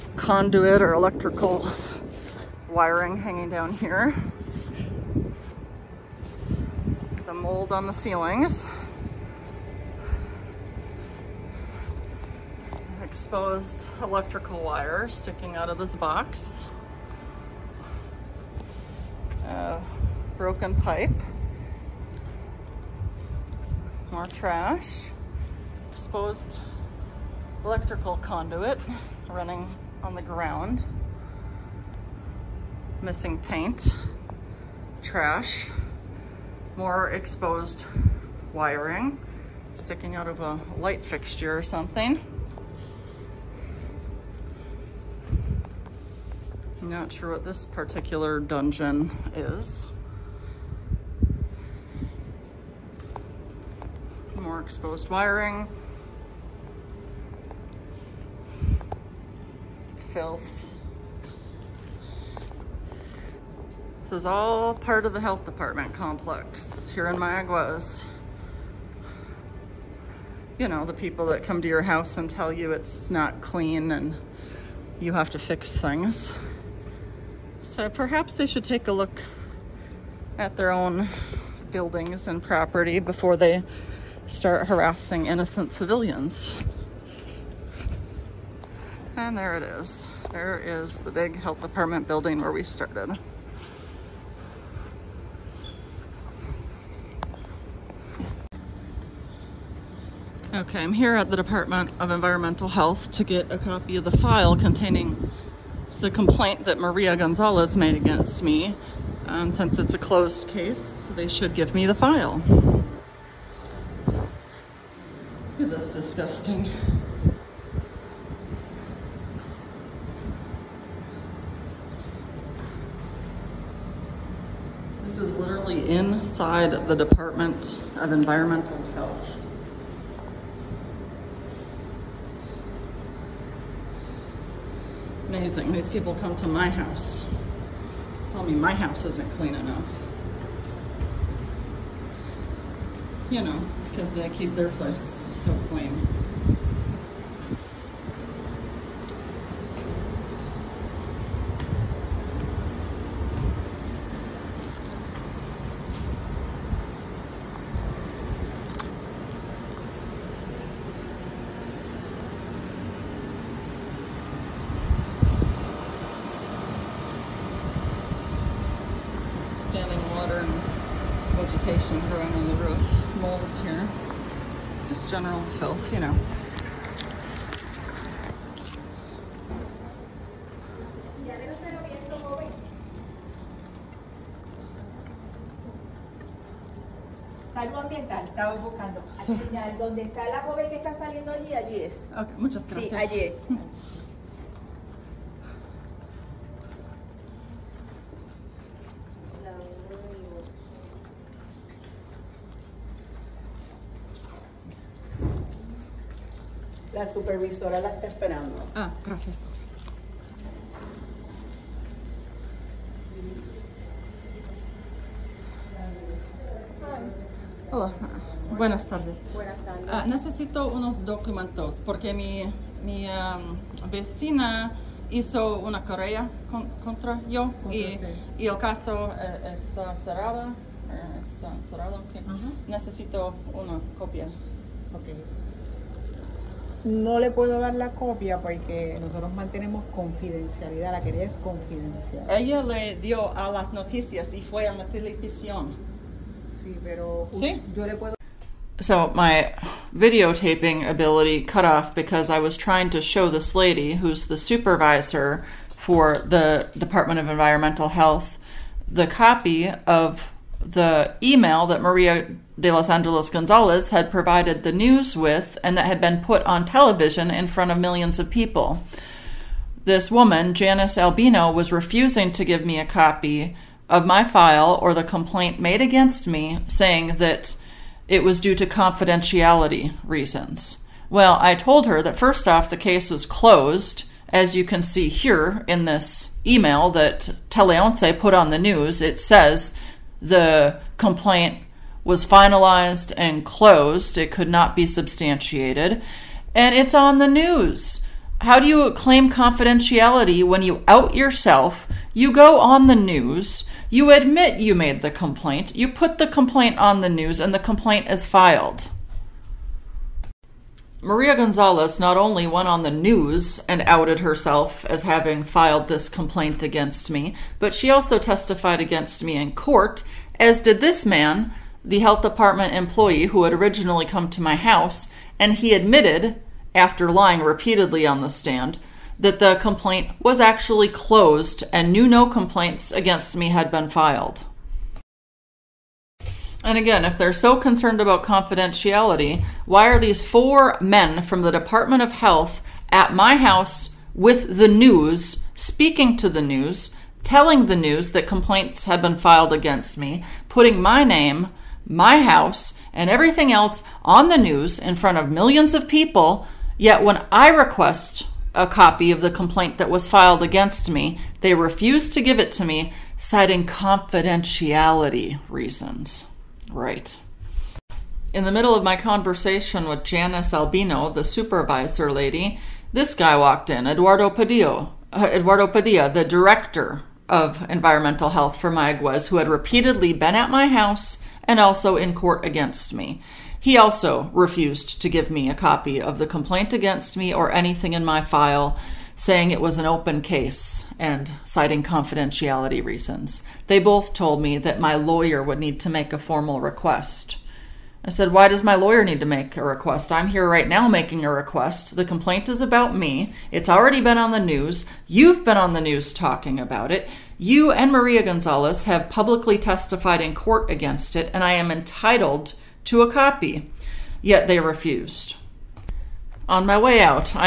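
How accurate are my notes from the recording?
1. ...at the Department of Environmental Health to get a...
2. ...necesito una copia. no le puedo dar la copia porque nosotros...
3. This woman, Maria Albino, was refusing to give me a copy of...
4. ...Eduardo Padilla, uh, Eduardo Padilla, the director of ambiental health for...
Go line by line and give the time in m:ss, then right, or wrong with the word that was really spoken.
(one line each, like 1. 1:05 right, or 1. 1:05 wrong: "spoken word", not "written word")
1. 1:41 right
2. 3:52 right
3. 4:29 wrong: "Janice", not "Maria"
4. 6:13 wrong: "environmental", not "ambiental".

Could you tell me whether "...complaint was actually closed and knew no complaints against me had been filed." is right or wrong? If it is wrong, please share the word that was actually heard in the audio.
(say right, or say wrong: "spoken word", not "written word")
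right.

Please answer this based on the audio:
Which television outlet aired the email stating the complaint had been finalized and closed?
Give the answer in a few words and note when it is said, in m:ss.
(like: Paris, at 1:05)
TeleOnce, at 4:47.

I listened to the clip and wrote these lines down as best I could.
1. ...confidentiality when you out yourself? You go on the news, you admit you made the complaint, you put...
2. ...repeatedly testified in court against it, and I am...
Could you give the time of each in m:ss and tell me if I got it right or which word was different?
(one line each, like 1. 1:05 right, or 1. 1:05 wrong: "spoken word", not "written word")
1. 4:59 right
2. 6:49 wrong: "publicly", not "repeatedly".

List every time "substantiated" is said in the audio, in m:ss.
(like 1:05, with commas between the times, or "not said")
4:54.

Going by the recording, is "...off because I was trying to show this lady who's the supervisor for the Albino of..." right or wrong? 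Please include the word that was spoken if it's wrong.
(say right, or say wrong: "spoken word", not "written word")
wrong: "Department", not "Albino".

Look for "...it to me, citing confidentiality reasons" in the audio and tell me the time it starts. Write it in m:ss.
6:02.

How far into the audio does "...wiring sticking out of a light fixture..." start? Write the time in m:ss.
0:38.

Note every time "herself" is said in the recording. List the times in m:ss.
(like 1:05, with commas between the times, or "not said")
5:14.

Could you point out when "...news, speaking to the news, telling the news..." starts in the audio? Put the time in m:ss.
5:44.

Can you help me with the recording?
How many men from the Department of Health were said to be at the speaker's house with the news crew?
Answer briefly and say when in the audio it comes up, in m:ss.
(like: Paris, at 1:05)
4, at 5:40.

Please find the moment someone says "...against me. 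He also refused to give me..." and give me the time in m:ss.
6:22.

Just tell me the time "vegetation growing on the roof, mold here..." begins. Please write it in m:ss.
2:51.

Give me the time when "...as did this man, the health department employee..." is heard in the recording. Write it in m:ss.
5:20.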